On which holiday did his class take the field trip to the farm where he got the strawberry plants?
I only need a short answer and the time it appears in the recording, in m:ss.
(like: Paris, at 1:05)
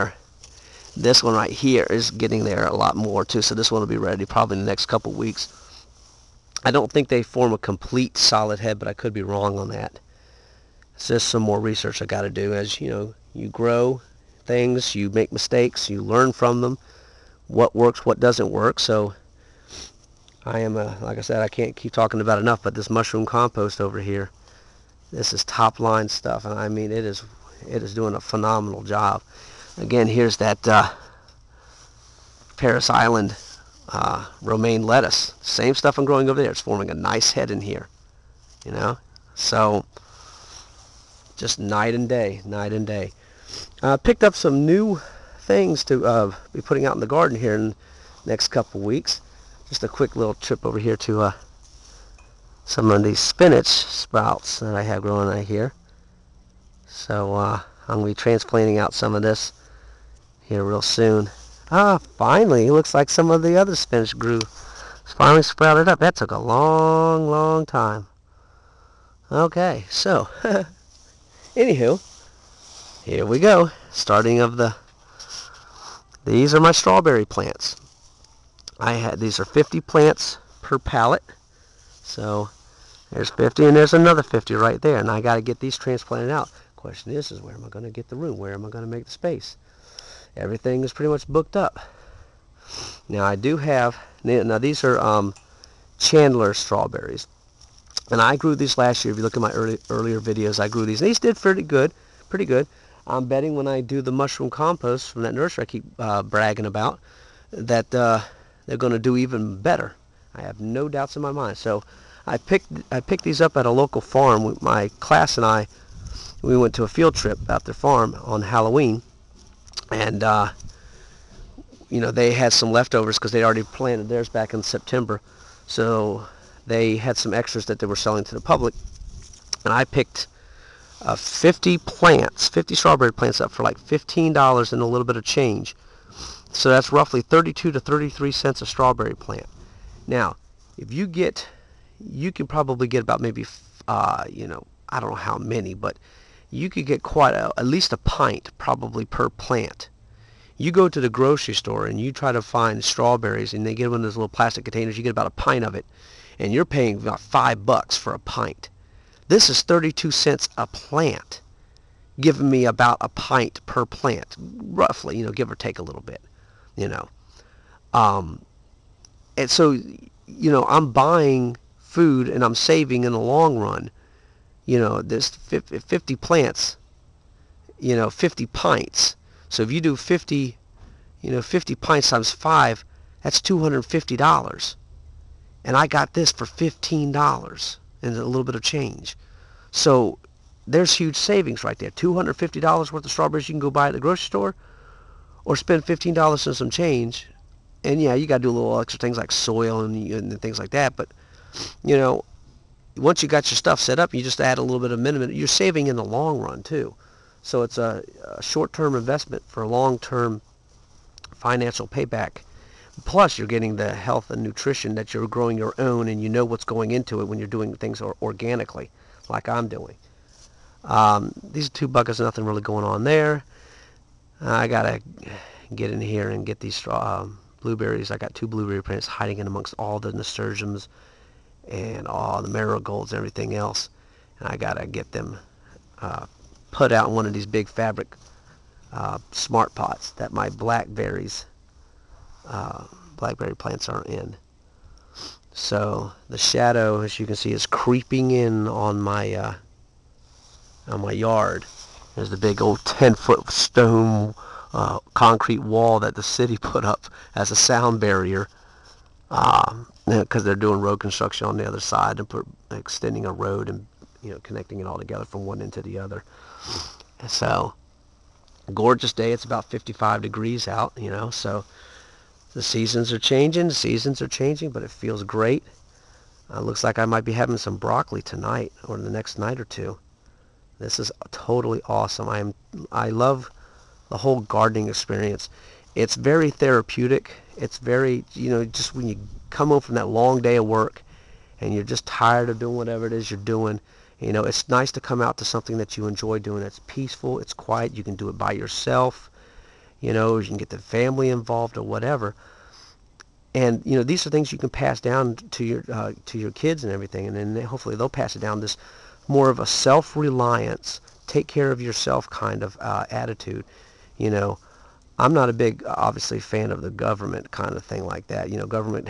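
Halloween, at 1:58.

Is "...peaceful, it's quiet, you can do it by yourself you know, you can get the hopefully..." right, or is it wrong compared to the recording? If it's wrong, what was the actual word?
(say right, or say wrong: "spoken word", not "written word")
wrong: "family", not "hopefully".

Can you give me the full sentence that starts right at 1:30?
Everything is pretty much booked up.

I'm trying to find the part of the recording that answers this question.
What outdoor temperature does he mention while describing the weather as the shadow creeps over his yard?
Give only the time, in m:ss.
4:29.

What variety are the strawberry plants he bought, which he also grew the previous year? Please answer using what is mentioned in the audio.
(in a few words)
Chandler.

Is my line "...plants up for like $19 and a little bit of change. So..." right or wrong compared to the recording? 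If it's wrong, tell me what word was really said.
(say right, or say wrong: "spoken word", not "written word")
wrong: "15", not "19".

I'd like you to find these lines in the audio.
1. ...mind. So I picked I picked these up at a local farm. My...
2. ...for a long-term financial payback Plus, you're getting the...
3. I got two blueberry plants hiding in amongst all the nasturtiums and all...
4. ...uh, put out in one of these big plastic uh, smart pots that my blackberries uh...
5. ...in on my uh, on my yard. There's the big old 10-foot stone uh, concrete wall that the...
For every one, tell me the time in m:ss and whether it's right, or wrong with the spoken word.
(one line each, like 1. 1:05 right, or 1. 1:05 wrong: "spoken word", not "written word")
1. 1:51 right
2. 3:29 right
3. 3:48 right
4. 3:55 wrong: "fabric", not "plastic"
5. 4:08 right.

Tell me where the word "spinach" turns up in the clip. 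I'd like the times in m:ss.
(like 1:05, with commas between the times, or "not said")
0:53, 1:03.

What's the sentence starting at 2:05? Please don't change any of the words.
So they had some extras that they were selling to the public.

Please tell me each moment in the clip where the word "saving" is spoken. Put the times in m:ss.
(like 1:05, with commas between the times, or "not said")
2:52, 3:11, 3:25.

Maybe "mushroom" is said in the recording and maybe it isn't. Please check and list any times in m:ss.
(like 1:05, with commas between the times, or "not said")
0:22, 1:44.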